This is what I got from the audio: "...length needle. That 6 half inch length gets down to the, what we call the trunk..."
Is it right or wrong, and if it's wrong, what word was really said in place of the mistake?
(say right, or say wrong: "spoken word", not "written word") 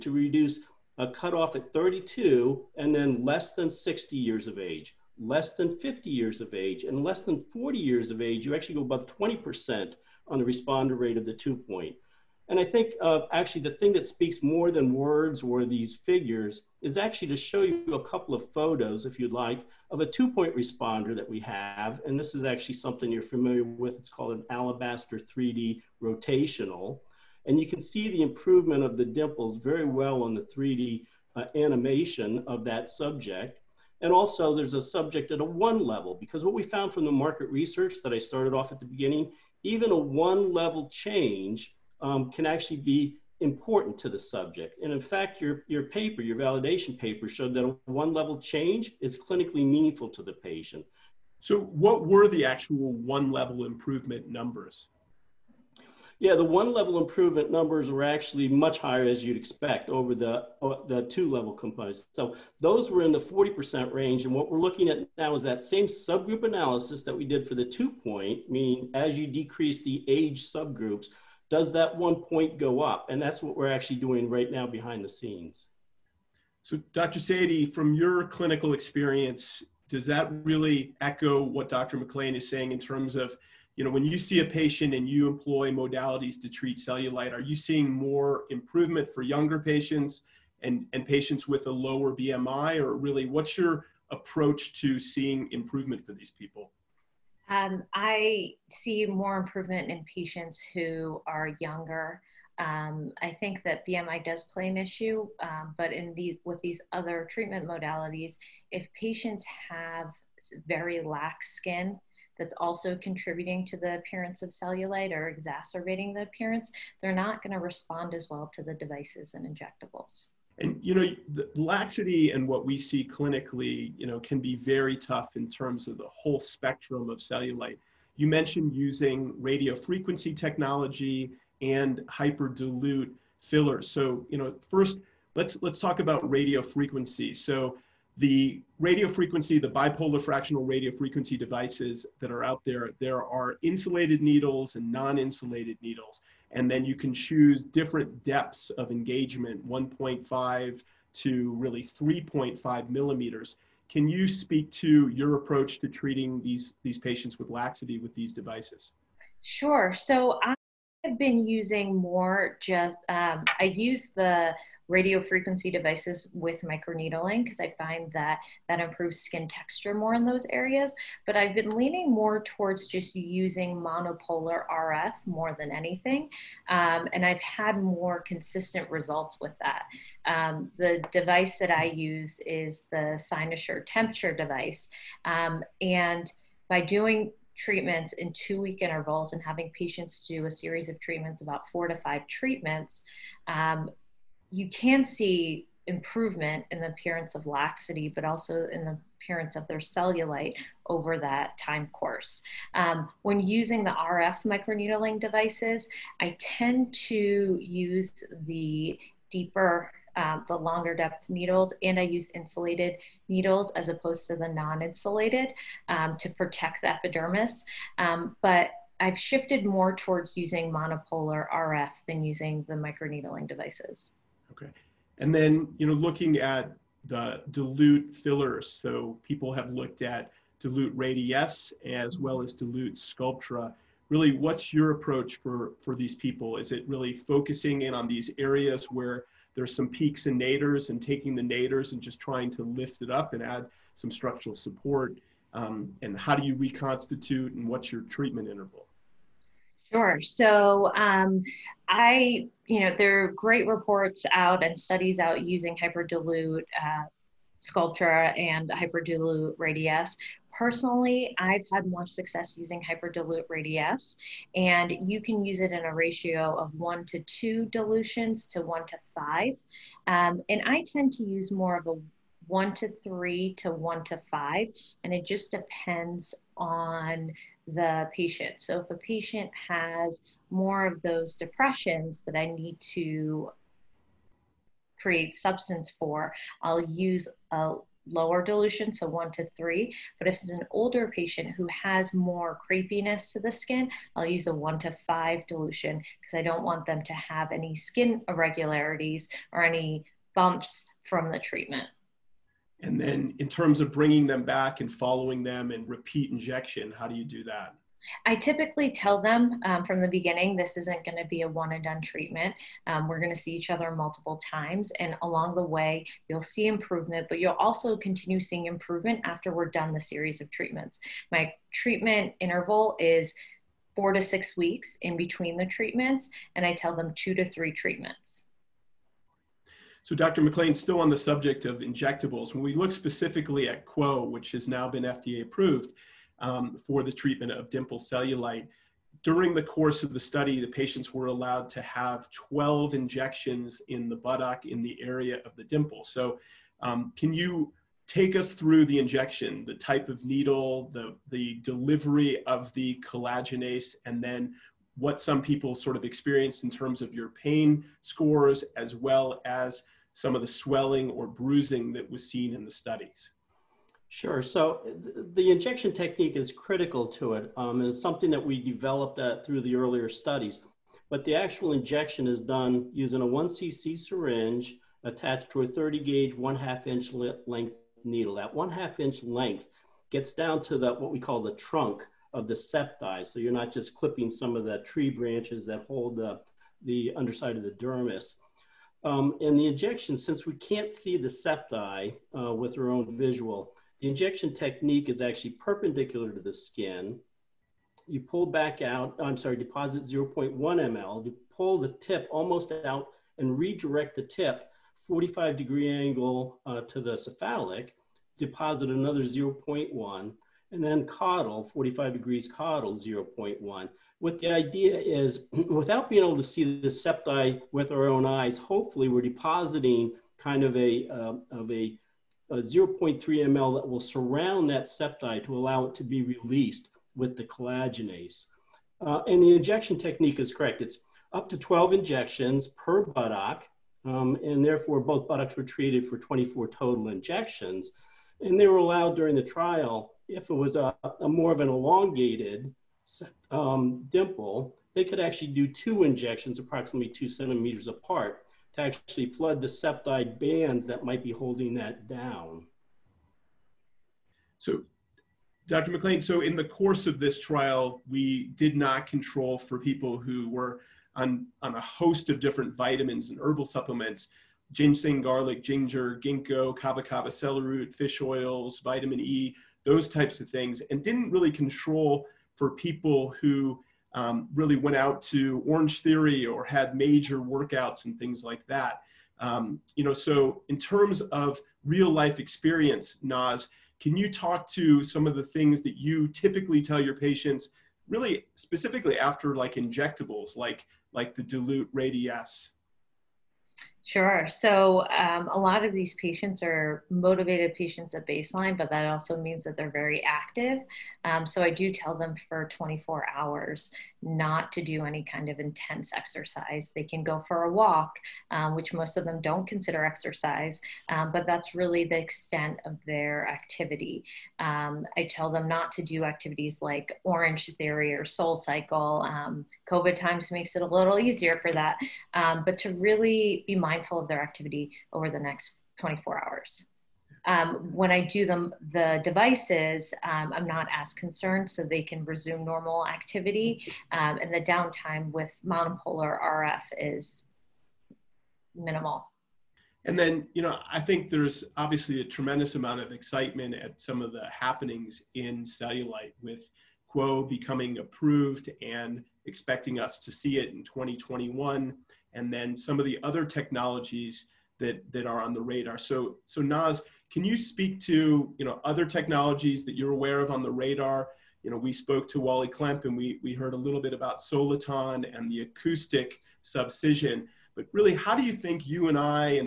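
wrong: "1", not "6".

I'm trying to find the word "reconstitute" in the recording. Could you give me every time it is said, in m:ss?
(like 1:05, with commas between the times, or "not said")
4:06.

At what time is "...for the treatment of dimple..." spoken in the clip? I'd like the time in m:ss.
5:36.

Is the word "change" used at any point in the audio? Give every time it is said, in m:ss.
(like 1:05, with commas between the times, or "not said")
0:40, 0:48.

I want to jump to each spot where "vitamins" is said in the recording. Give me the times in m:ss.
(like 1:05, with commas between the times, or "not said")
7:42, 7:48.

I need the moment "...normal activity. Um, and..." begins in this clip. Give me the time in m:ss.
8:52.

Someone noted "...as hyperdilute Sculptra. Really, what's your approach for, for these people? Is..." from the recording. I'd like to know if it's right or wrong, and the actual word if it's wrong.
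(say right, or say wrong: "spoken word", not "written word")
wrong: "dilute", not "hyperdilute".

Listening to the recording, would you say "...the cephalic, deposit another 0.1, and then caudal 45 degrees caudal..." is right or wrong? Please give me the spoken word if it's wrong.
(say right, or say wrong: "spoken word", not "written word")
right.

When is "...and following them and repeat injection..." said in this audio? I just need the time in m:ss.
5:04.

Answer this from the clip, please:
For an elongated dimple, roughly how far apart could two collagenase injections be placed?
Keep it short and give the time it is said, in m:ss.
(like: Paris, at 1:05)
2 centimeters, at 7:27.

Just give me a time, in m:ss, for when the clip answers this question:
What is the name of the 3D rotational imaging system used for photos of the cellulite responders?
0:24.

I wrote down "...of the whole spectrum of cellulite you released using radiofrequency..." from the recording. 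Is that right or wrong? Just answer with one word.
wrong.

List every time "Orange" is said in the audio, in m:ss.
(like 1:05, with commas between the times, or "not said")
7:55, 8:37.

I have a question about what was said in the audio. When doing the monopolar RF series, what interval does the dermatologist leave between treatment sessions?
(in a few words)
2 weeks.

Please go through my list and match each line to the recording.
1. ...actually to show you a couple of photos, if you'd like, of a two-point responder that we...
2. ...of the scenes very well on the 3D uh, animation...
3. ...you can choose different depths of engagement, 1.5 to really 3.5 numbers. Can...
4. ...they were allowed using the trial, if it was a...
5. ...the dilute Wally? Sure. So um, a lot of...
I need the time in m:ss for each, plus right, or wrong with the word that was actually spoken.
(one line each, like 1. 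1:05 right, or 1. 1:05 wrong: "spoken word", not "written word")
1. 0:16 right
2. 0:28 wrong: "dimples", not "scenes"
3. 2:26 wrong: "millimeters", not "numbers"
4. 7:18 wrong: "during", not "using"
5. 8:11 wrong: "Radiesse", not "Wally".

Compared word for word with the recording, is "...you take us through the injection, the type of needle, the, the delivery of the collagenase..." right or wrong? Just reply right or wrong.
right.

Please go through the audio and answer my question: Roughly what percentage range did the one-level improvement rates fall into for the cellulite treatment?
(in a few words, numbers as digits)
40%.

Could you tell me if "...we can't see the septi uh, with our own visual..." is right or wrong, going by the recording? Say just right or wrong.
right.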